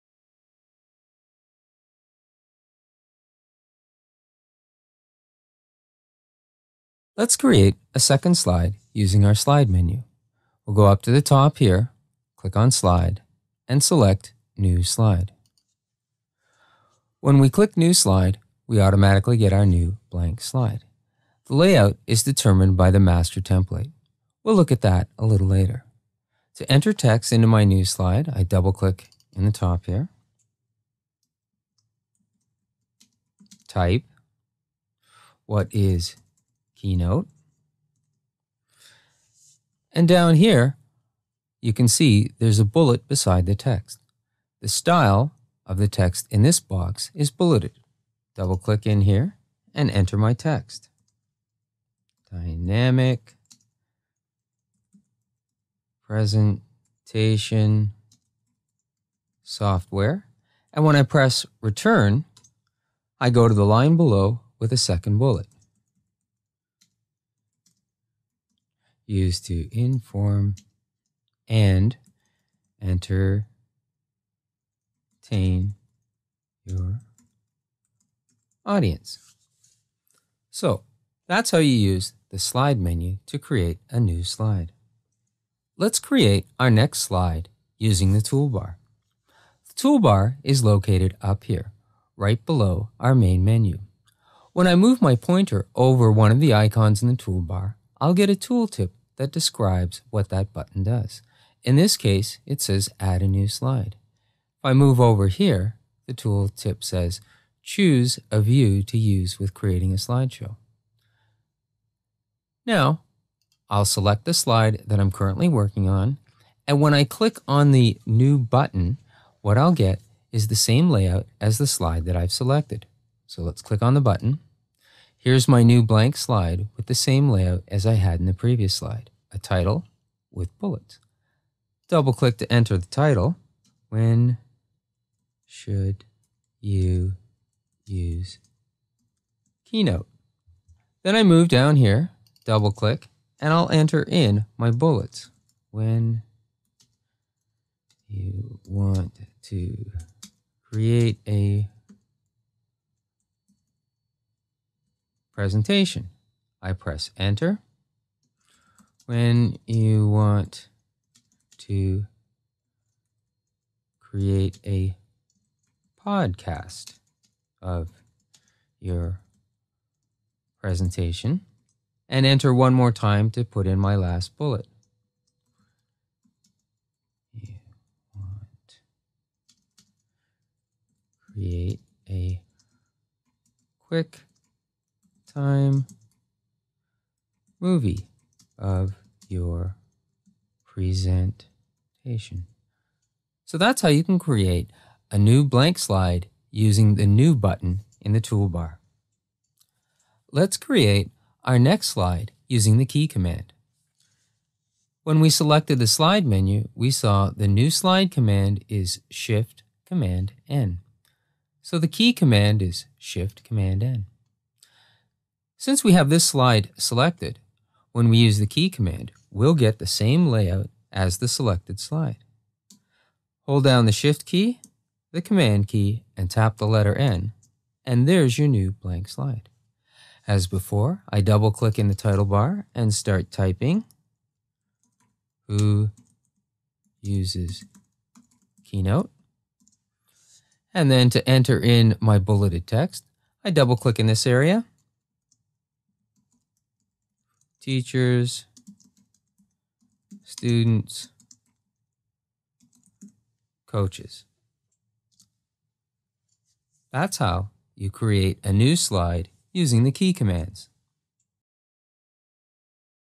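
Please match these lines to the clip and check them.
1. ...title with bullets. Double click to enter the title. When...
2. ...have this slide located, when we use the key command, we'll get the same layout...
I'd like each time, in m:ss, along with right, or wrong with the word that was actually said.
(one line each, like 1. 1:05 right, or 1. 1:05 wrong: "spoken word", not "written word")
1. 2:09 right
2. 3:35 wrong: "selected", not "located".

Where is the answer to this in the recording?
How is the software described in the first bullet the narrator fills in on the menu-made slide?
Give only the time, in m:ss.
0:52.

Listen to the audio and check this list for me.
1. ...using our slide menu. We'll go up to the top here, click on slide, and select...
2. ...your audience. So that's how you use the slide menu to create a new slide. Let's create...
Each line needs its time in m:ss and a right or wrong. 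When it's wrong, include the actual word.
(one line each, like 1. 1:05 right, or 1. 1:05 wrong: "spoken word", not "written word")
1. 0:08 right
2. 1:16 right.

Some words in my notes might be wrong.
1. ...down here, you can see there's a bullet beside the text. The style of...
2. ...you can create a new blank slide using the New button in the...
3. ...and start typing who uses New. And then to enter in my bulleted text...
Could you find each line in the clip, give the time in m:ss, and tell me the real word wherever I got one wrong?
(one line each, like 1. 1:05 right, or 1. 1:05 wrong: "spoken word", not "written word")
1. 0:40 right
2. 3:13 right
3. 3:52 wrong: "Keynote", not "New".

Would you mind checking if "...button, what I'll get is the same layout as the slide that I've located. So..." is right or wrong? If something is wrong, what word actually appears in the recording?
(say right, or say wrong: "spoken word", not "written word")
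wrong: "selected", not "located".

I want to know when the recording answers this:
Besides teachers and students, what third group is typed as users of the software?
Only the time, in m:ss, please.
4:13.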